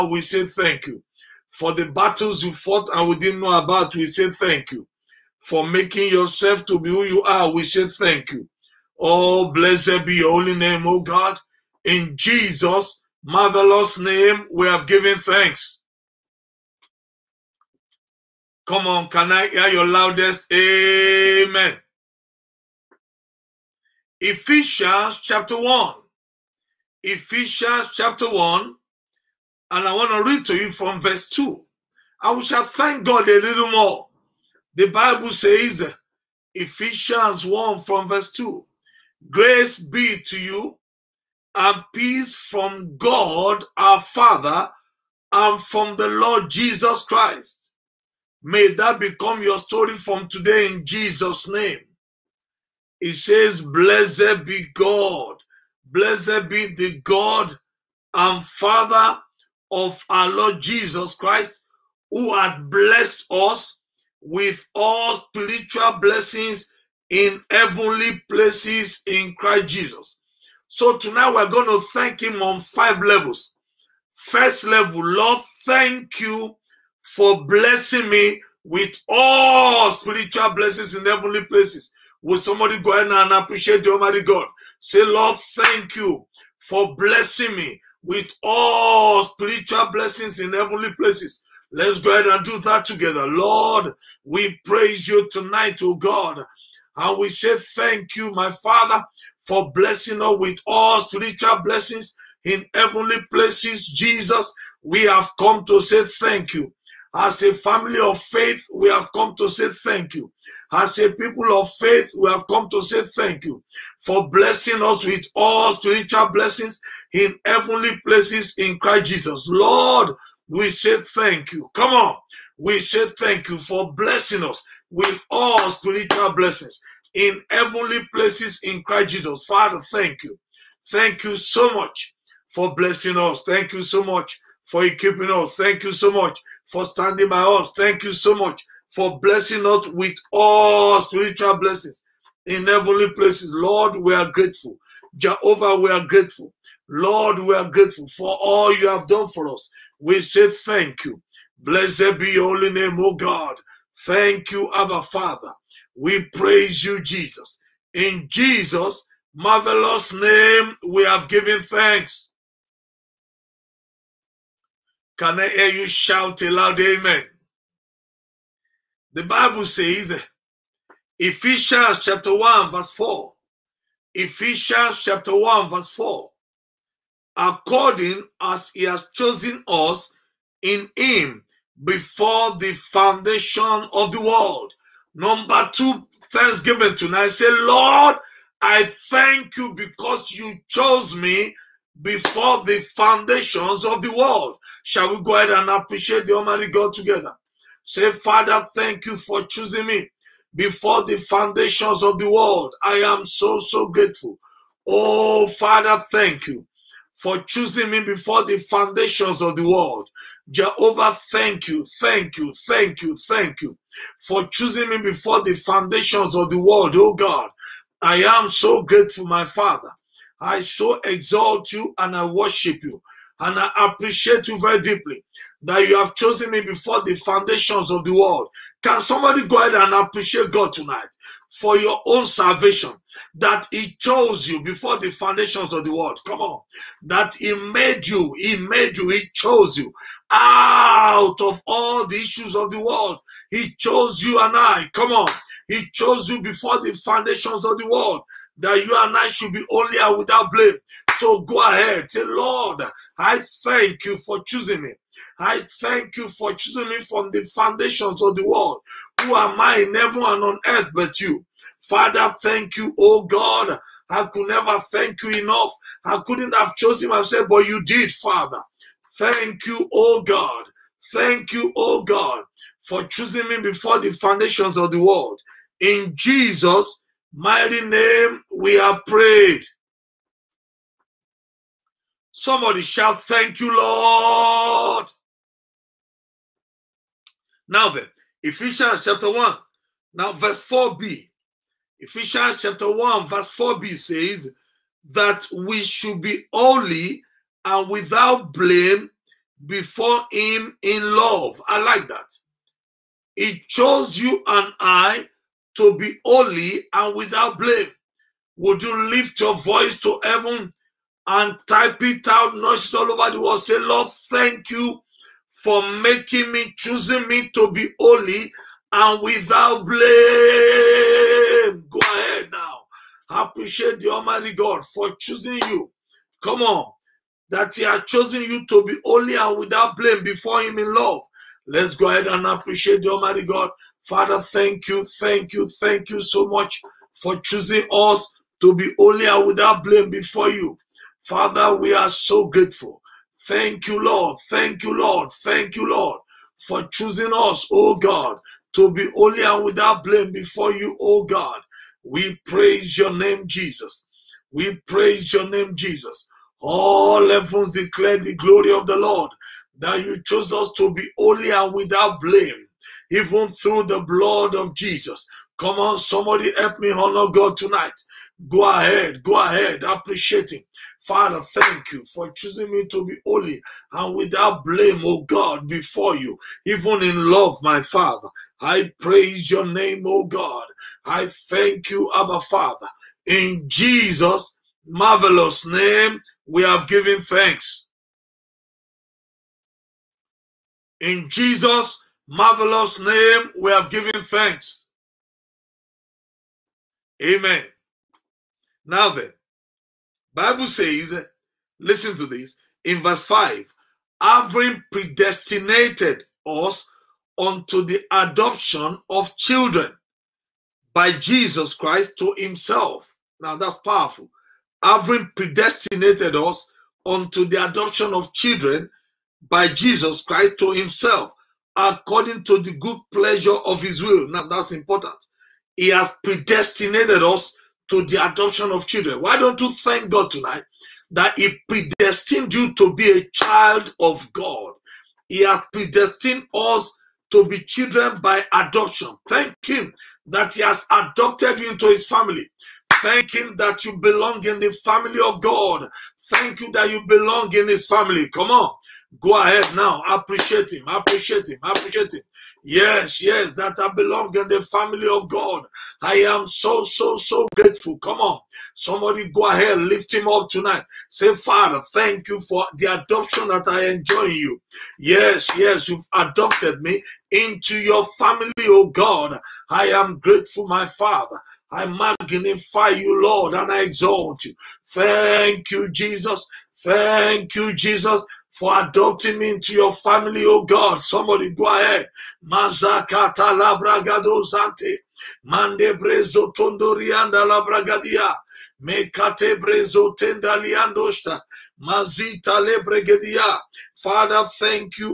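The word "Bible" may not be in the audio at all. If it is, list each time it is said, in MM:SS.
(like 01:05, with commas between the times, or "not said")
00:34, 02:49, 06:40.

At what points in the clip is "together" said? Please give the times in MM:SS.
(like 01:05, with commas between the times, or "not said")
01:32, 03:16.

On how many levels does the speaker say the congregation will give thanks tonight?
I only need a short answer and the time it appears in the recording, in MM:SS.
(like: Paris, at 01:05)
Five, at 01:12.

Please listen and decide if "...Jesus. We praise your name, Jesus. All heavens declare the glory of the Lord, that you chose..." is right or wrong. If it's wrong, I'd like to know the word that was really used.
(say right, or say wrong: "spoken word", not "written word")
right.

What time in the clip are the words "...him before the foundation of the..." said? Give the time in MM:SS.
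03:00.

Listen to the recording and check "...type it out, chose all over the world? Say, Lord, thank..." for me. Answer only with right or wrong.
wrong.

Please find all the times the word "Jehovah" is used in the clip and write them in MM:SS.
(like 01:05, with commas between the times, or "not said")
02:25, 03:30.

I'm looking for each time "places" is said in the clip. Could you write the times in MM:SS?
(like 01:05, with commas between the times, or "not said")
01:08, 01:21, 01:30, 01:43, 01:58, 02:08, 02:23.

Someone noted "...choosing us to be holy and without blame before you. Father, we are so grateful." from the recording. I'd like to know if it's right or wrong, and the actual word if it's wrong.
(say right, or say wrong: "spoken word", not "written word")
right.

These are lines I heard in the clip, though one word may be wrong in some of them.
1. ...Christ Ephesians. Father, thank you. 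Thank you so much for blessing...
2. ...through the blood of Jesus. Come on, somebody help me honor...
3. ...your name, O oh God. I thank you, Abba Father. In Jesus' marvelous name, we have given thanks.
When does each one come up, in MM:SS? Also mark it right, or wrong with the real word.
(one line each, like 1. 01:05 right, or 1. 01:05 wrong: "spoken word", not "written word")
1. 02:08 wrong: "Jesus", not "Ephesians"
2. 06:03 right
3. 06:19 right.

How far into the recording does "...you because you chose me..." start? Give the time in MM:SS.
03:09.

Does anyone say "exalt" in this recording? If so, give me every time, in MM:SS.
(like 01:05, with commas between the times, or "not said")
03:41, 07:53.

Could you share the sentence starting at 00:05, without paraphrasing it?
For making yourself to be who you are, we say thank you.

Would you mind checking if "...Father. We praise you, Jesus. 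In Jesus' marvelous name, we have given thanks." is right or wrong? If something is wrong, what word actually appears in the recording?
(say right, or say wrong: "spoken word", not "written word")
right.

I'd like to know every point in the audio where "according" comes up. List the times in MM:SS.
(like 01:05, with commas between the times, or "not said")
02:57, 07:01.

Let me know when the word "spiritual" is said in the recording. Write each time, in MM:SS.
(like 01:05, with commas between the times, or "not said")
01:05, 01:19, 01:29, 01:41, 01:55, 02:05, 02:21.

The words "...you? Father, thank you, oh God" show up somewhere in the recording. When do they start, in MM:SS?
04:21.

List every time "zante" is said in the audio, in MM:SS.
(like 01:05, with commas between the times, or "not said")
08:04.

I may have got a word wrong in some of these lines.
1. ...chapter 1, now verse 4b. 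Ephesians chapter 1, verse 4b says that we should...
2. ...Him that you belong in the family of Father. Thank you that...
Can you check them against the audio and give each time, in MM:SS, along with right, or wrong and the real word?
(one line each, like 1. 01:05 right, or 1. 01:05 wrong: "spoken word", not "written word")
1. 04:49 right
2. 07:23 wrong: "God", not "Father".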